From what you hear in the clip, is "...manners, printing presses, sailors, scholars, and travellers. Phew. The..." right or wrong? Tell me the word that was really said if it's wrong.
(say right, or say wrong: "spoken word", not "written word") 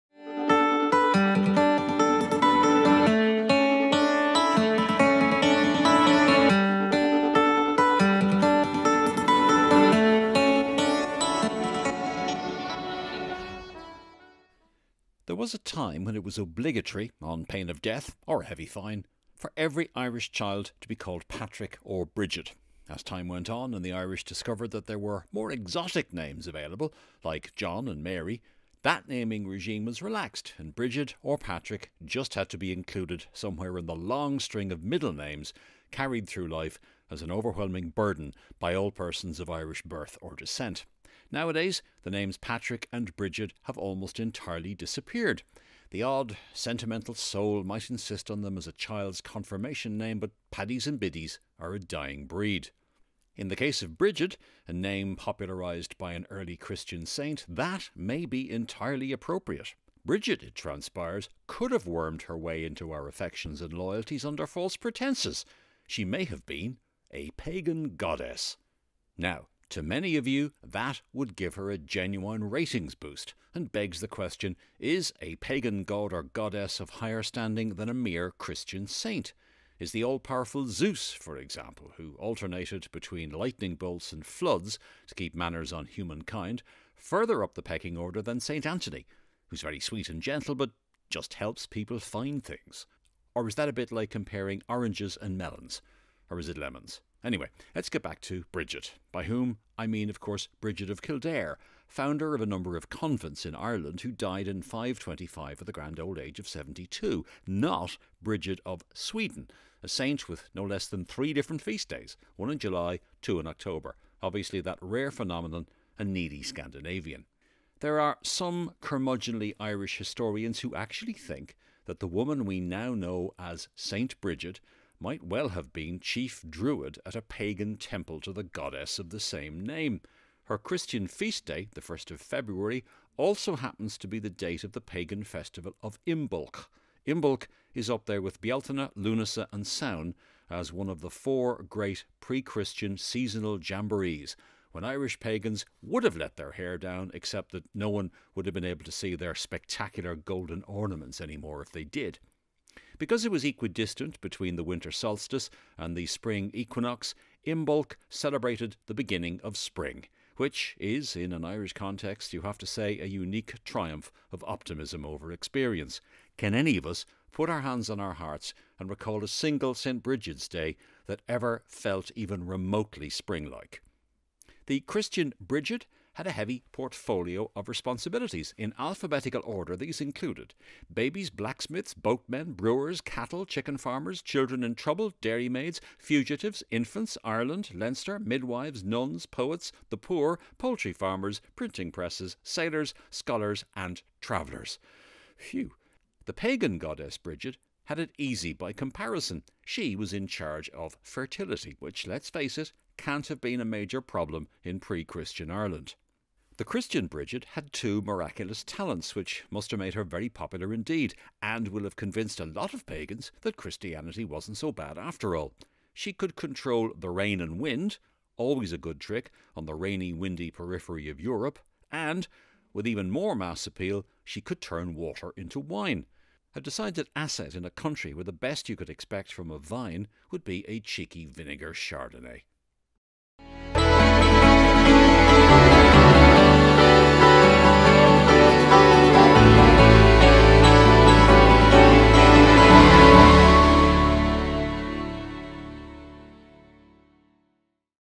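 wrong: "farmers", not "manners".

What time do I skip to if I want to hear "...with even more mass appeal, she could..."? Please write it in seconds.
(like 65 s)
222 s.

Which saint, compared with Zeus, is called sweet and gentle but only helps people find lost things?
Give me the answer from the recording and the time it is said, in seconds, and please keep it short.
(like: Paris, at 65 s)
St. Anthony, at 88 s.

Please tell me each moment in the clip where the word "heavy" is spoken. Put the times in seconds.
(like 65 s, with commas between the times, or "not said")
18 s, 176 s.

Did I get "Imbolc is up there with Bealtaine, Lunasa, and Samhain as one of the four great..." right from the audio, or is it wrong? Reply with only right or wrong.
right.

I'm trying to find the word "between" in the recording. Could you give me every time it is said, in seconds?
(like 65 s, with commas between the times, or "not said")
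82 s, 154 s.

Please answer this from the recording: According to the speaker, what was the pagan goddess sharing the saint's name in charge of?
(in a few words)
Fertility.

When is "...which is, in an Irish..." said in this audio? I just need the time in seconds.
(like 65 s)
160 s.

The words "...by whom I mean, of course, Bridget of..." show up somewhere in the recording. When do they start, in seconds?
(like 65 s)
99 s.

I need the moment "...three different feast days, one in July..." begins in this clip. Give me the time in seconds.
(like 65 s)
111 s.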